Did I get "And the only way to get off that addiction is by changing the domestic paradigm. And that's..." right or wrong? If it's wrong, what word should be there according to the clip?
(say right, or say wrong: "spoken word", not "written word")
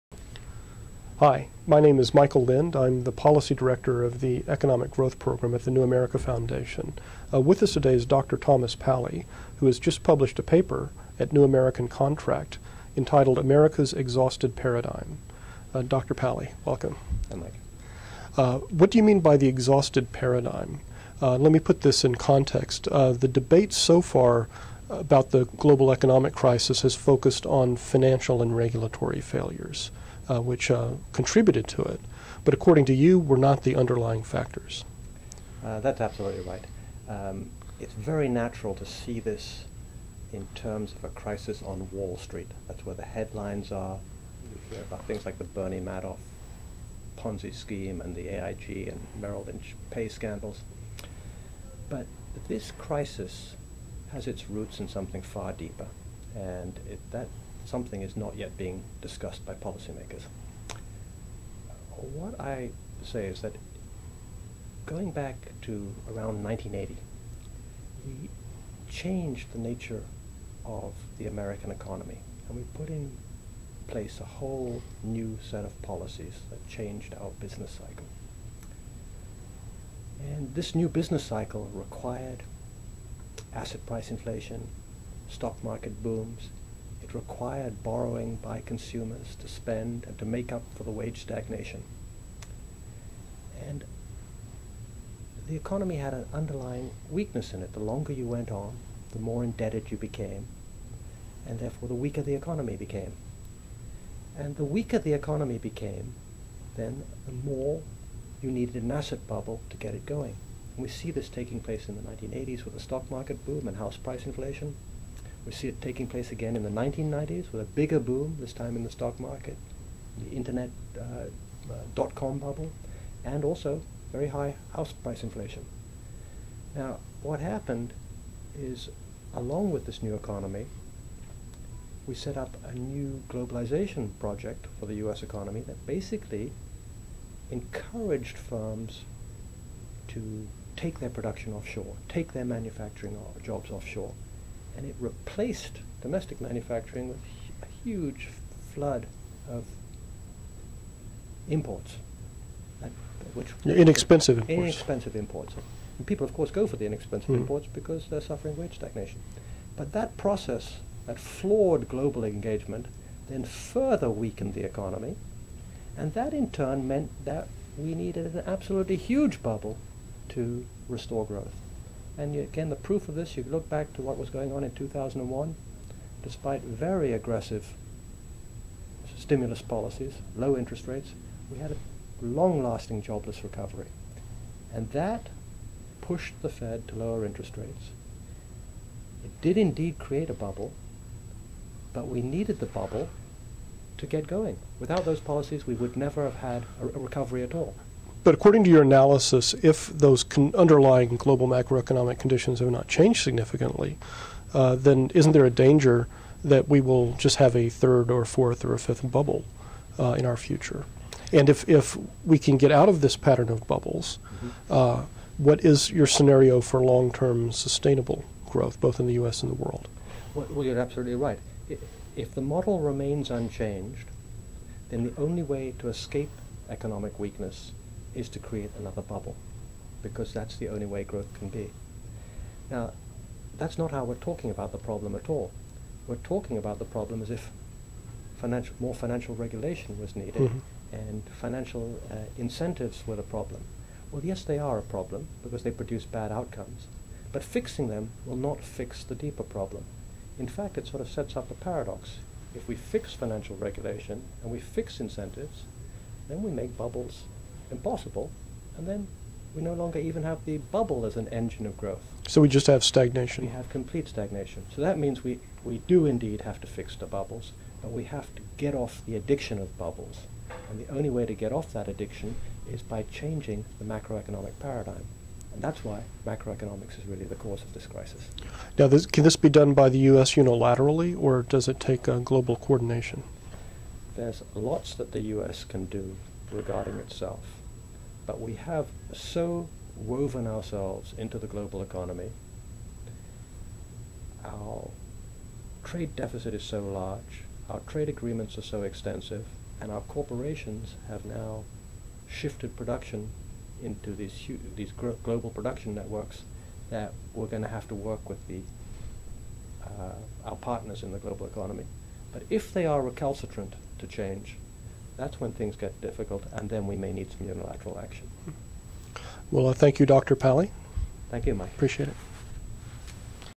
wrong: "macroeconomic", not "domestic".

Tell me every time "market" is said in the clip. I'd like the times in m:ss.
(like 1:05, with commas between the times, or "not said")
1:25, 1:53, 1:59.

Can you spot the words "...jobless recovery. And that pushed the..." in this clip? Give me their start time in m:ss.
3:03.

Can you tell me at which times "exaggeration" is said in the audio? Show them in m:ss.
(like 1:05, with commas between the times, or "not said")
not said.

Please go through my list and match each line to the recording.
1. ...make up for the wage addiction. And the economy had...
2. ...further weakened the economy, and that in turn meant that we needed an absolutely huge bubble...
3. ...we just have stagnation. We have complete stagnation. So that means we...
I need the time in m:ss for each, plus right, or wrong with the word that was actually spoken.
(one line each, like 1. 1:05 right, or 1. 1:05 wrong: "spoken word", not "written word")
1. 1:30 wrong: "stagnation", not "addiction"
2. 2:43 right
3. 4:22 right.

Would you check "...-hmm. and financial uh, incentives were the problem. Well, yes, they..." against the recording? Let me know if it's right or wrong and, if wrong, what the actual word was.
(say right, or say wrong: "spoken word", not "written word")
right.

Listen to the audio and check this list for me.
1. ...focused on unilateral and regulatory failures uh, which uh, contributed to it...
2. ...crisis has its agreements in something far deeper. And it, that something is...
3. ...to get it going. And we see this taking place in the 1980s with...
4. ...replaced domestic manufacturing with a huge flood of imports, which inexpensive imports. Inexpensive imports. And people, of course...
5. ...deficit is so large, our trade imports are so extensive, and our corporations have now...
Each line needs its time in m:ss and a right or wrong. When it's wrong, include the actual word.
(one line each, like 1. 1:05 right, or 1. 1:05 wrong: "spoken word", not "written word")
1. 0:26 wrong: "financial", not "unilateral"
2. 0:52 wrong: "roots", not "agreements"
3. 1:49 right
4. 2:24 right
5. 4:56 wrong: "agreements", not "imports".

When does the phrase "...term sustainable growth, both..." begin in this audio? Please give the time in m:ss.
3:37.